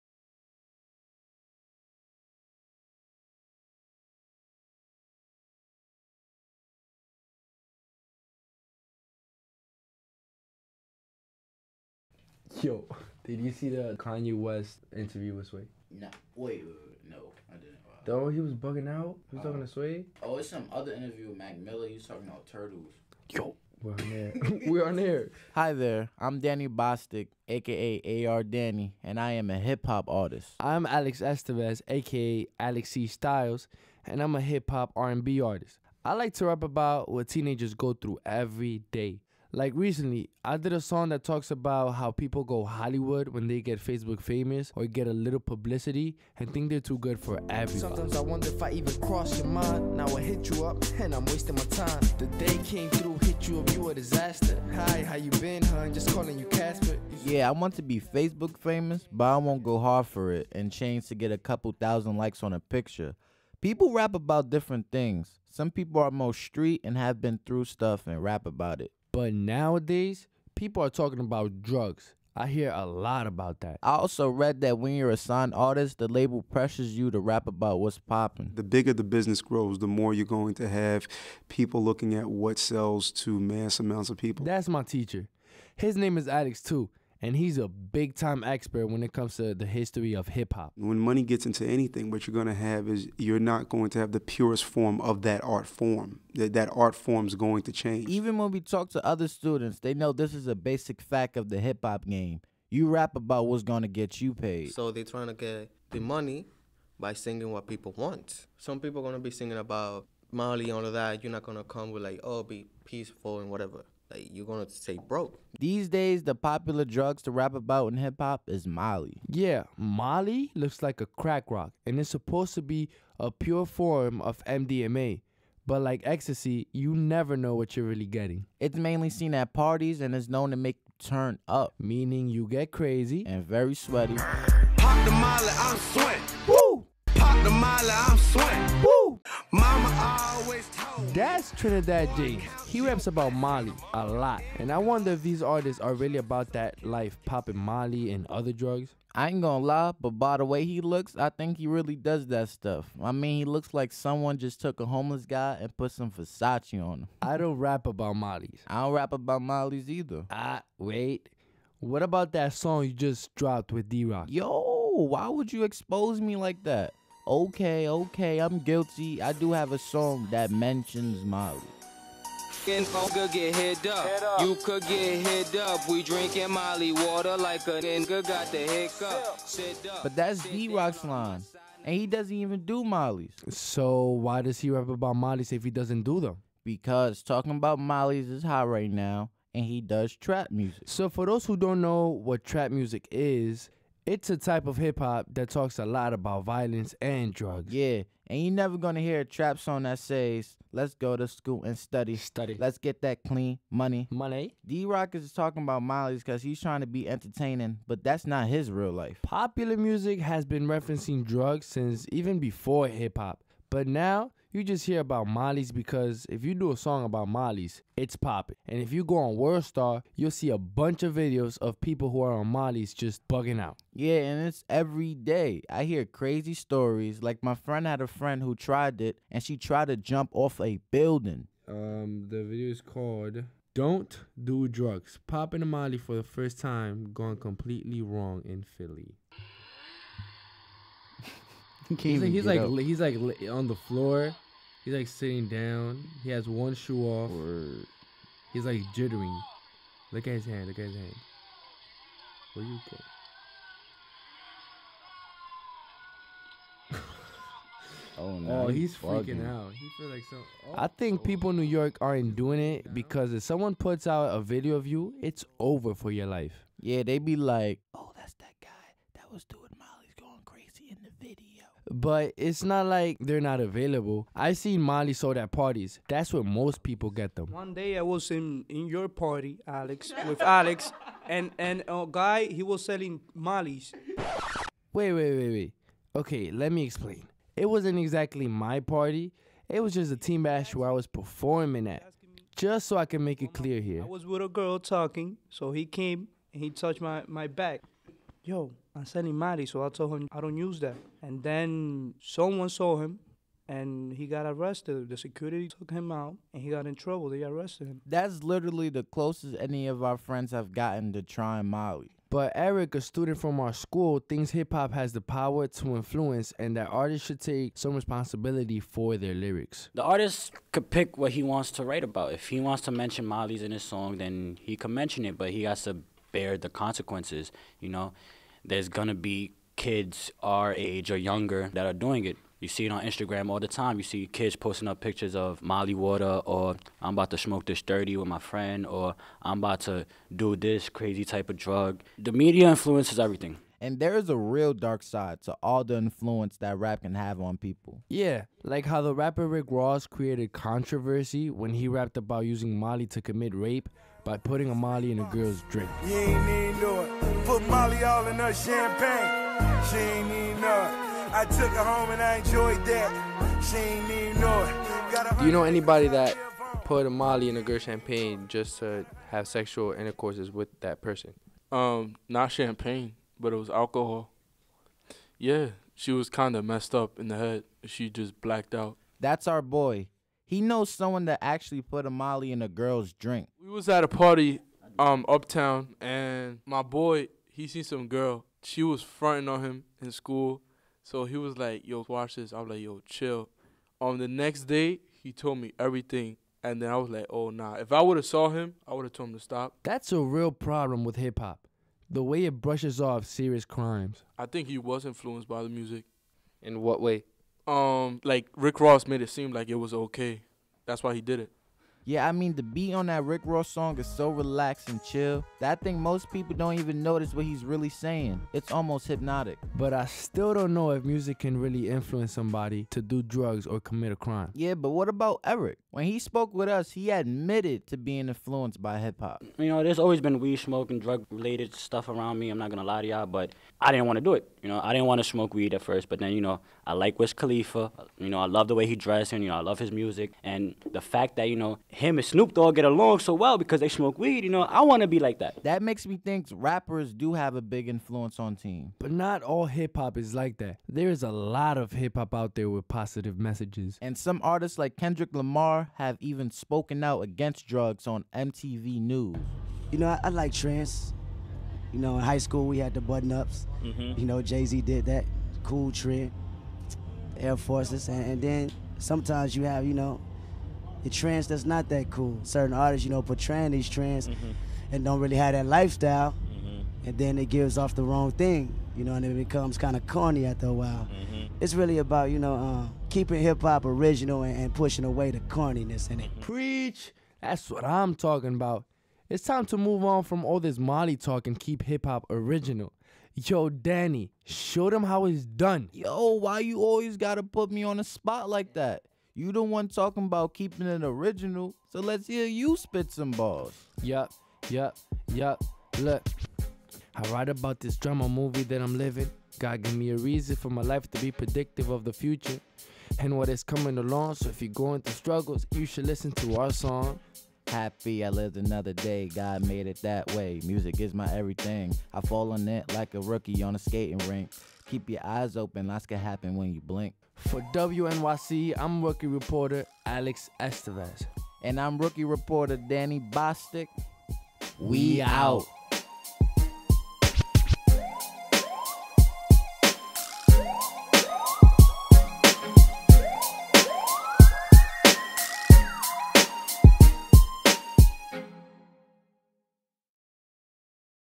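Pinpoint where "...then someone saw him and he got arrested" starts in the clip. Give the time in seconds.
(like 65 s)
301 s.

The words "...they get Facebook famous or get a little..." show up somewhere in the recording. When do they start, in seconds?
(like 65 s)
43 s.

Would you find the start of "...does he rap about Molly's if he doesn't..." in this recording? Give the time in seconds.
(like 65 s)
184 s.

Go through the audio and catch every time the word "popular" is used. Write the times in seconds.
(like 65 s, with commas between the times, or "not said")
116 s, 209 s.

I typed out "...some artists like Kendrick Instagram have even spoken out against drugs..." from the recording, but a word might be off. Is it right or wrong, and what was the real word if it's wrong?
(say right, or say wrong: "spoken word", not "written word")
wrong: "Lamar", not "Instagram".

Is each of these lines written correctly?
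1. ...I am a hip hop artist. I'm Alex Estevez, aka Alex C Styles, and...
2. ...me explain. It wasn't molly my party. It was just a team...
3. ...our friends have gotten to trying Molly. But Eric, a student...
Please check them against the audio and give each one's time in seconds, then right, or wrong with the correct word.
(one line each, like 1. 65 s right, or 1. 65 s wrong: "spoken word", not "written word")
1. 29 s right
2. 286 s wrong: "exactly", not "molly"
3. 310 s right.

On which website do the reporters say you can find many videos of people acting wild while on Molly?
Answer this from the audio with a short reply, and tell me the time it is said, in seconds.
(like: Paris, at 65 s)
WorldStar, at 219 s.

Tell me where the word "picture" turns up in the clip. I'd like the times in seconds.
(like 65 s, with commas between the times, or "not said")
62 s, 335 s.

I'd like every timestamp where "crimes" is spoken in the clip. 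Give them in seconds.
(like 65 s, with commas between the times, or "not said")
403 s, 424 s.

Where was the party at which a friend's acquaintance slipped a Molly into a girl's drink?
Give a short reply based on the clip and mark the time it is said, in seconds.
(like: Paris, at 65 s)
Uptown, at 385 s.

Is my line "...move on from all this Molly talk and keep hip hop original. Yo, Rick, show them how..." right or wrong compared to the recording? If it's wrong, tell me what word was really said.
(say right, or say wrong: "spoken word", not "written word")
wrong: "Danny", not "Rick".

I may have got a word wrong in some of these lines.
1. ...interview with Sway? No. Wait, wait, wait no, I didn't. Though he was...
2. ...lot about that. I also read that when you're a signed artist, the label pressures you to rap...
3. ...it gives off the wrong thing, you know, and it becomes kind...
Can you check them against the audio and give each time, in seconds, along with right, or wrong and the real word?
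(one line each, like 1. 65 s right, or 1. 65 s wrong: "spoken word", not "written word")
1. 14 s right
2. 72 s right
3. 477 s right.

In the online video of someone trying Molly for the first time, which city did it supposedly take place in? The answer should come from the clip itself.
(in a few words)
Philly.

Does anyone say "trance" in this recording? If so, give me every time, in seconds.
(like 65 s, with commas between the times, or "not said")
460 s, 471 s.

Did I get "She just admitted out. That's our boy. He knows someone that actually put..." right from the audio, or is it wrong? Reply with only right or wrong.
wrong.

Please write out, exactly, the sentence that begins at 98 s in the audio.
Even when we talk to other students, they know this is a basic fact of the hip hop game.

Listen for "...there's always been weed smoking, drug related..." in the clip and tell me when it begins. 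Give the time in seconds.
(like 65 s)
429 s.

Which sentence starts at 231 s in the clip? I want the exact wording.
Um, the video is called don't do drugs.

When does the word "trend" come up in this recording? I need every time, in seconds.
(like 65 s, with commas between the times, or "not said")
465 s, 473 s.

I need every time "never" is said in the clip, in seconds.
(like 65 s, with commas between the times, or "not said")
126 s, 198 s.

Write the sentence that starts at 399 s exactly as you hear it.
That's a real problem with hip hop.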